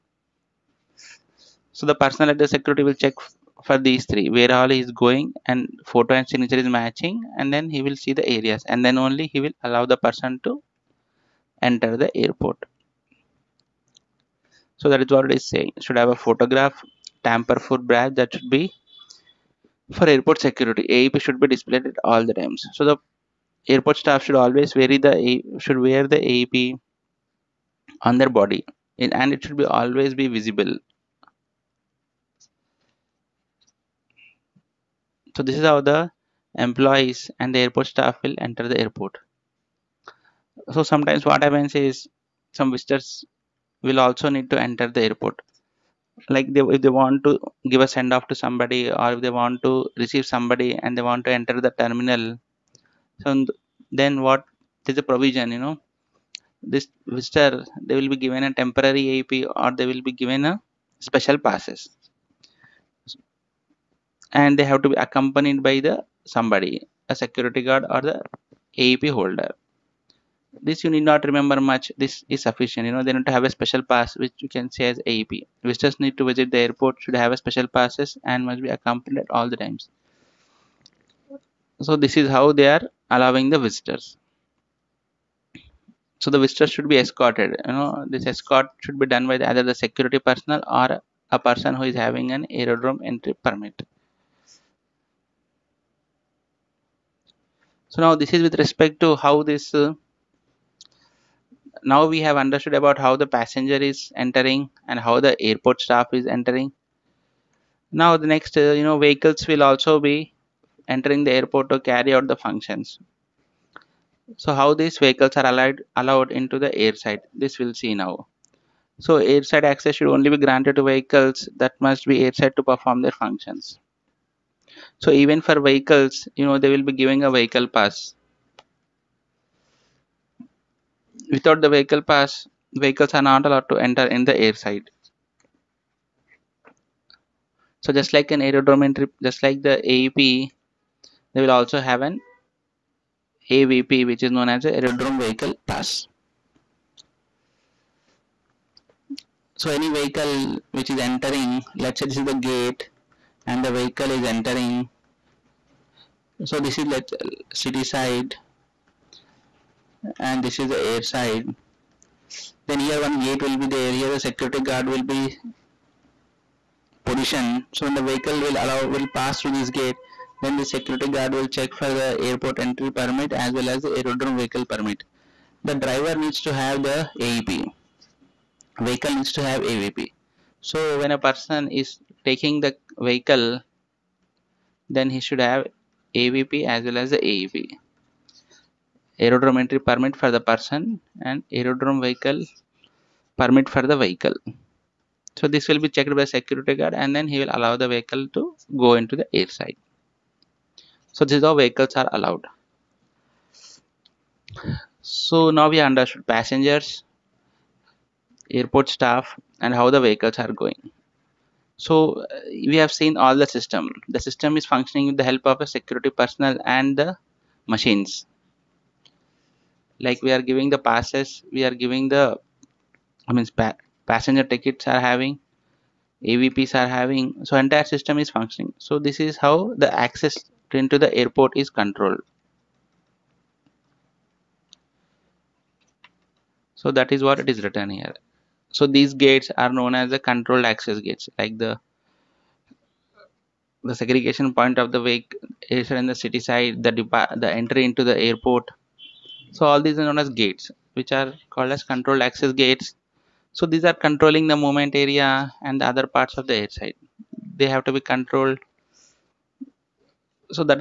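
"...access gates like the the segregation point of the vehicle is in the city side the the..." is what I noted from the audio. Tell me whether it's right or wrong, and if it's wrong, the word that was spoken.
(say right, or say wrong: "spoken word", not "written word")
right.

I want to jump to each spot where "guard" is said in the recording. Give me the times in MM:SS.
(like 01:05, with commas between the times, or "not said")
01:07, 02:44, 02:51, 03:16.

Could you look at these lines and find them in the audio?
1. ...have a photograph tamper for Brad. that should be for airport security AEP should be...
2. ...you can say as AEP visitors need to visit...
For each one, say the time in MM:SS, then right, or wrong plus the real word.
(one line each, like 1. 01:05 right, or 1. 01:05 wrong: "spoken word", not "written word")
1. 00:15 right
2. 01:14 right.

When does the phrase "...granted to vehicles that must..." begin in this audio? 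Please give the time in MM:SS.
02:00.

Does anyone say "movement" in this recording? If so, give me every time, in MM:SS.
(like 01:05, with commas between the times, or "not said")
04:14.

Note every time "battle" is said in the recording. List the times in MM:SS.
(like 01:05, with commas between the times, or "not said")
not said.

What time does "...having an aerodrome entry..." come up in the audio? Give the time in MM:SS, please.
01:31.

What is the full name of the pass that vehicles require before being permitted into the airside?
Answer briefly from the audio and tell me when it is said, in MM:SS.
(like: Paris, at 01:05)
Aerodrome vehicle pass, at 02:24.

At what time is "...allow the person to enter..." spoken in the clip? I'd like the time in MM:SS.
00:09.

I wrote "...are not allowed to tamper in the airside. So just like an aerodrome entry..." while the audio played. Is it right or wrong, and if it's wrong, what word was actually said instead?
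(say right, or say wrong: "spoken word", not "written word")
wrong: "enter", not "tamper".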